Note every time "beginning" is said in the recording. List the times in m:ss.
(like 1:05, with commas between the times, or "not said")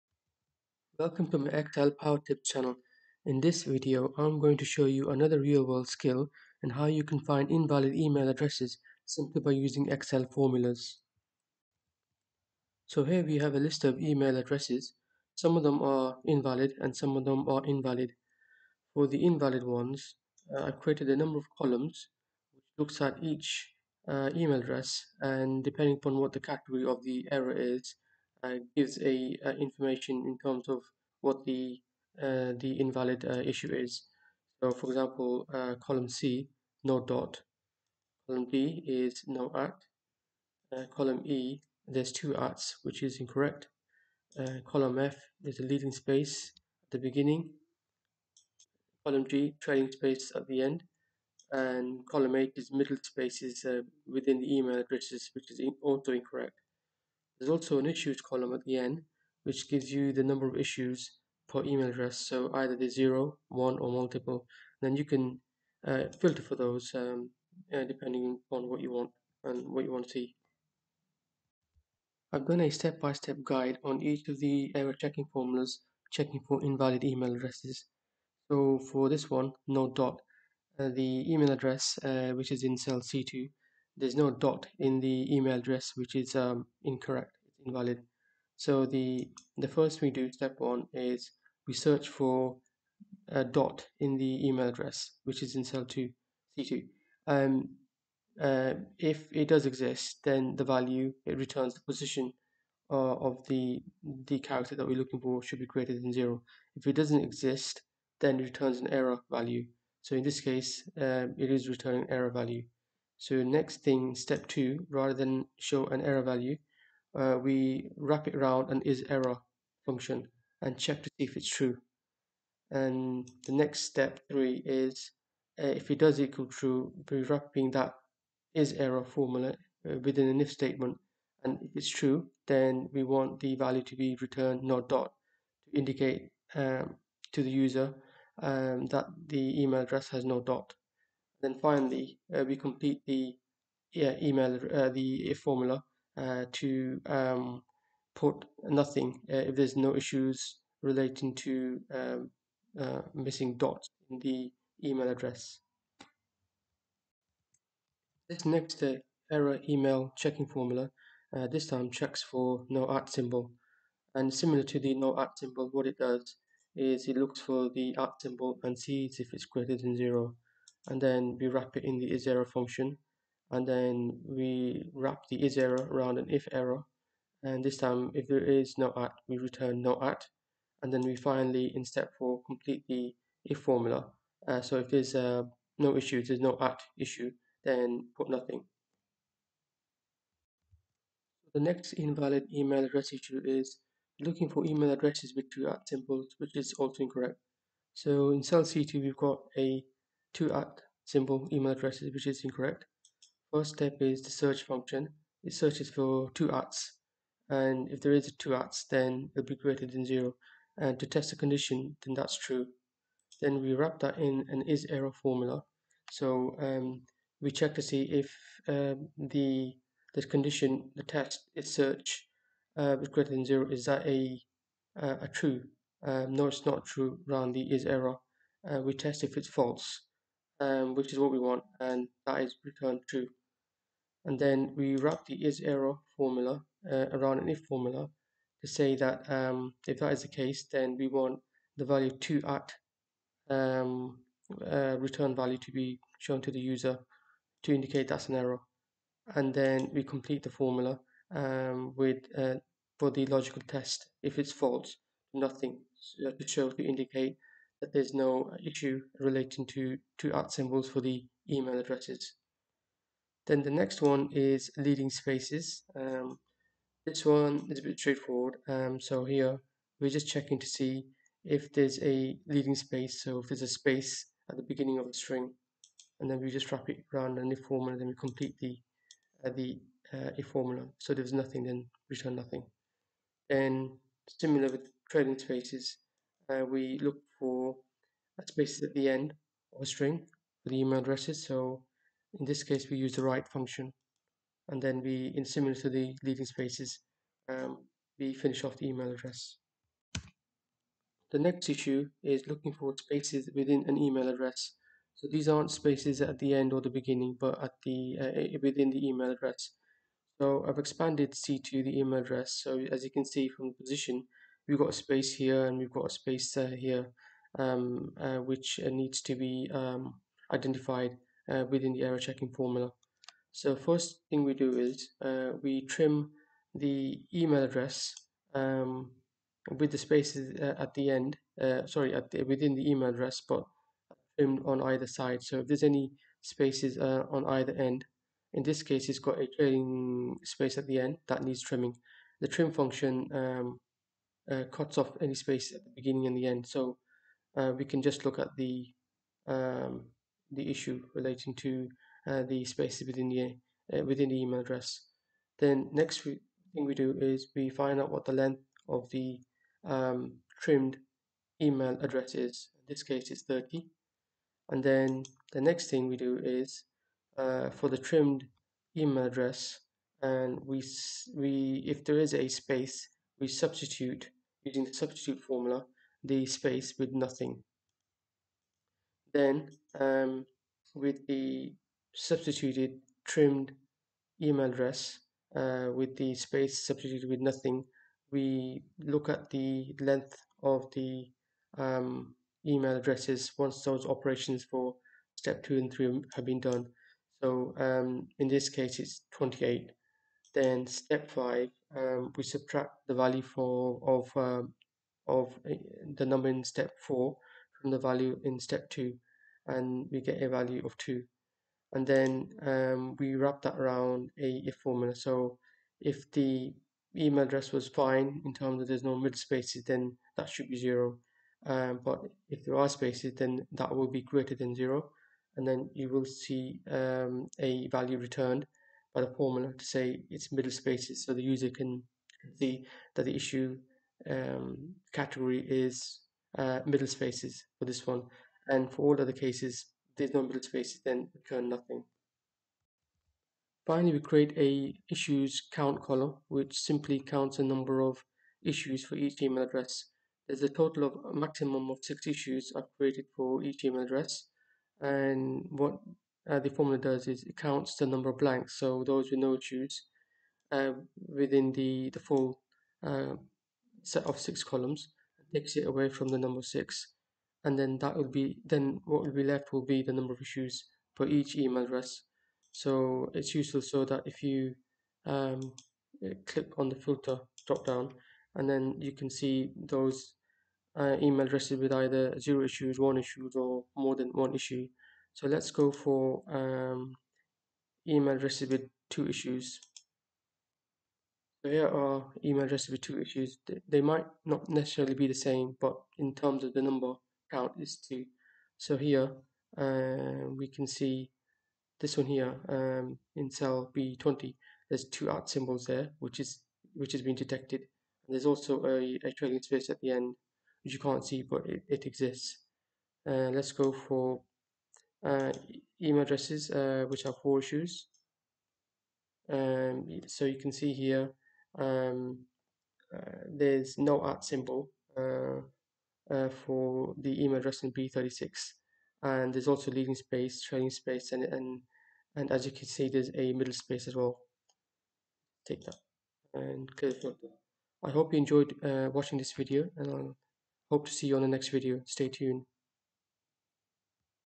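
0:46, 4:34, 5:06, 5:45.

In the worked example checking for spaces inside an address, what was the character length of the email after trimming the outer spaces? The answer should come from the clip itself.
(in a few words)
30.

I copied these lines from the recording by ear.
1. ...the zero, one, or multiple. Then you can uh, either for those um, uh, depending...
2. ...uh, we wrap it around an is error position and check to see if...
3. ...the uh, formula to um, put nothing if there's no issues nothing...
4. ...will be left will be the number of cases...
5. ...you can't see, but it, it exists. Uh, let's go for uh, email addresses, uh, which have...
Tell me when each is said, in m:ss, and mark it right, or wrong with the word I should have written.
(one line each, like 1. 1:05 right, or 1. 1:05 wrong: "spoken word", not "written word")
1. 1:02 wrong: "filter", not "either"
2. 1:57 wrong: "function", not "position"
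3. 2:24 wrong: "relating", not "nothing"
4. 7:49 wrong: "issues", not "cases"
5. 8:30 right.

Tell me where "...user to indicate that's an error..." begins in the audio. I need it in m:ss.
4:06.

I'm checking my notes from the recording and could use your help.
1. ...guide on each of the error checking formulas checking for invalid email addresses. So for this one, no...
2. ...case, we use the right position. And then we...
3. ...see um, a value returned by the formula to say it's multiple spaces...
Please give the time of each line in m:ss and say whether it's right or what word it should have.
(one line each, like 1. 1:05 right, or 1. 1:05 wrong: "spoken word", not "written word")
1. 1:13 right
2. 4:52 wrong: "function", not "position"
3. 7:06 wrong: "middle", not "multiple".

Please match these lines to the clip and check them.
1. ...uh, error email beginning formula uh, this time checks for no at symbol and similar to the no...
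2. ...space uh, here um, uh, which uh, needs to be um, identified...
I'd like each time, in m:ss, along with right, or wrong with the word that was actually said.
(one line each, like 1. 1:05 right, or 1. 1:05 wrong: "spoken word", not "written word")
1. 2:38 wrong: "checking", not "beginning"
2. 5:16 right.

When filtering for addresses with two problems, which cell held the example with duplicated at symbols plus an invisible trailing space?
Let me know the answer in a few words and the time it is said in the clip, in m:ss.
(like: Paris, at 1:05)
B20, at 8:23.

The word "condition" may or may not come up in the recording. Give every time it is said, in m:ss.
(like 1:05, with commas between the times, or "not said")
3:31, 3:40.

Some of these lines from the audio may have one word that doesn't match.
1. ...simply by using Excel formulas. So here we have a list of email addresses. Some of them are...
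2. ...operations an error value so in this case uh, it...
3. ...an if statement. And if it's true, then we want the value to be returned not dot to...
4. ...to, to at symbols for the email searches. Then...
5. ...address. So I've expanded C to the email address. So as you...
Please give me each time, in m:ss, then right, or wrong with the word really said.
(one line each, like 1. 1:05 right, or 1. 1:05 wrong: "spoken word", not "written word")
1. 0:09 right
2. 1:48 wrong: "returns", not "operations"
3. 2:10 right
4. 4:19 wrong: "addresses", not "searches"
5. 5:09 right.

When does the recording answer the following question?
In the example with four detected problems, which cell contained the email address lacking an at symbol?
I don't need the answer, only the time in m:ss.
8:47.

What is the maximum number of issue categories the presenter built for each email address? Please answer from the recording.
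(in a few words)
6.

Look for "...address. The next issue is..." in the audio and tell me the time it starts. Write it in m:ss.
4:59.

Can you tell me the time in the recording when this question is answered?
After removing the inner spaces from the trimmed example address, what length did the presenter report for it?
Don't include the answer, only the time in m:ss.
6:38.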